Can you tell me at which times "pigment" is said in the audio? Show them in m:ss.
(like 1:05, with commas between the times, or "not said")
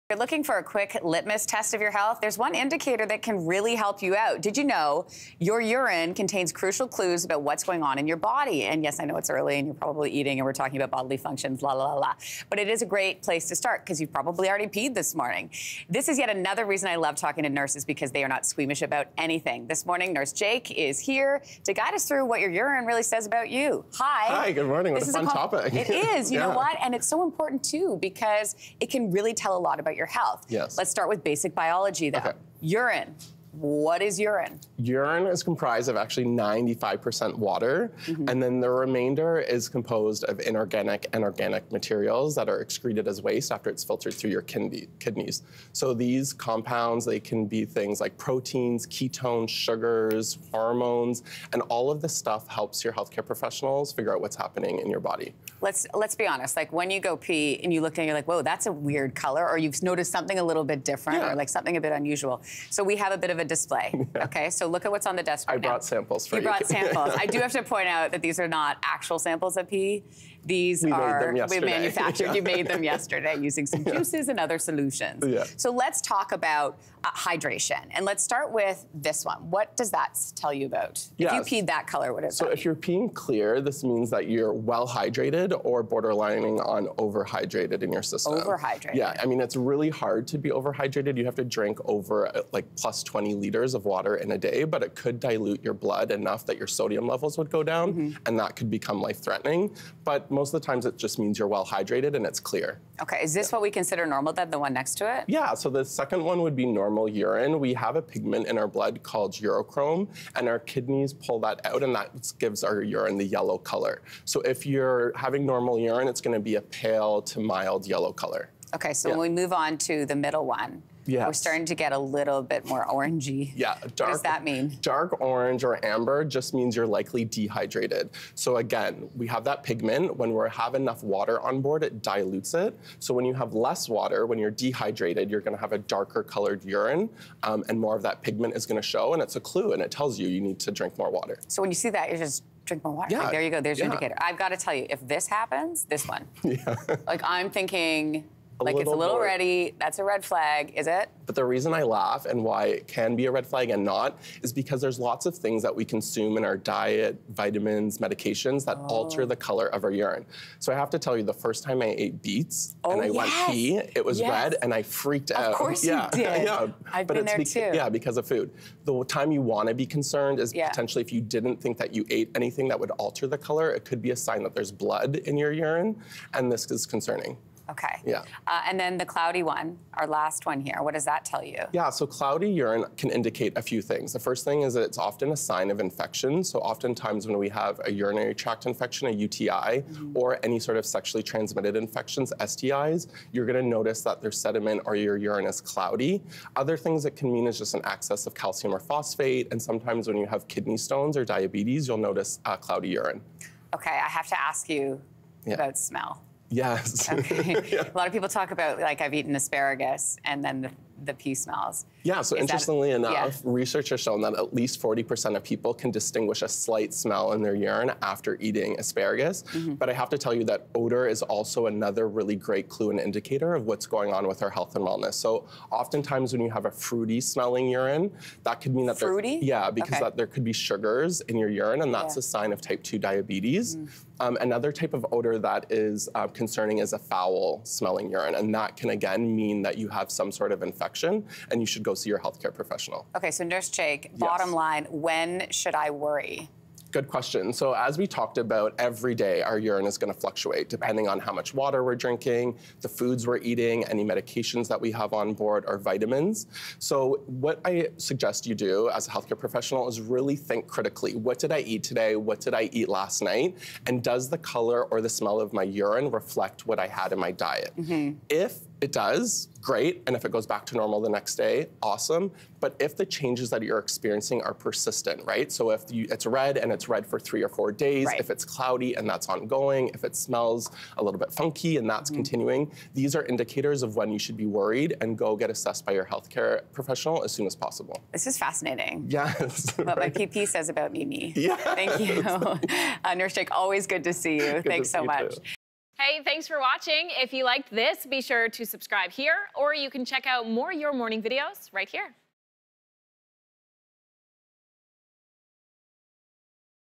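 1:48, 2:09, 2:18.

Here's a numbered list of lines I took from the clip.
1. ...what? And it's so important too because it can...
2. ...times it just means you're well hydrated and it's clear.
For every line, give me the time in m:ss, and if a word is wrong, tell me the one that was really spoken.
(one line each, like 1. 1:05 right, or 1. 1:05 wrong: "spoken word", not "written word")
1. 0:26 right
2. 1:40 right.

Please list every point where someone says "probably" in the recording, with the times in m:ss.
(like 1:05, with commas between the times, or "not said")
0:09, 0:14.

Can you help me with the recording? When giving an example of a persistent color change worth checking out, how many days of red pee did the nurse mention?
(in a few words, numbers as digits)
3 or 4 days.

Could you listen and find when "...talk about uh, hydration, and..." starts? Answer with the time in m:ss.
1:16.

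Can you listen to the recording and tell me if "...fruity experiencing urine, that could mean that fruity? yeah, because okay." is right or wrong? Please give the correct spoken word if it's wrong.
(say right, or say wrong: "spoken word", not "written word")
wrong: "smelling", not "experiencing".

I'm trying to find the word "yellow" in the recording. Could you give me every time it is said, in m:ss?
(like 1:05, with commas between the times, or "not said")
1:53, 1:57.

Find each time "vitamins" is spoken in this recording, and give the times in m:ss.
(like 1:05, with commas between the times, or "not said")
2:37, 4:15.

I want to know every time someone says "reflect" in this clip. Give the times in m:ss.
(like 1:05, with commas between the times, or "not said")
4:26.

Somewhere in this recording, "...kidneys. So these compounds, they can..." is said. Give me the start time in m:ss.
0:45.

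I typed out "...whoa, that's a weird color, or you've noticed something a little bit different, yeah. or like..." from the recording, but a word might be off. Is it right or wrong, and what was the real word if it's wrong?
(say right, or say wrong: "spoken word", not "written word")
right.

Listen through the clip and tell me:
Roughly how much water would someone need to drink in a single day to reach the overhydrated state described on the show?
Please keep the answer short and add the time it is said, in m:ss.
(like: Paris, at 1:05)
20 liters, at 1:33.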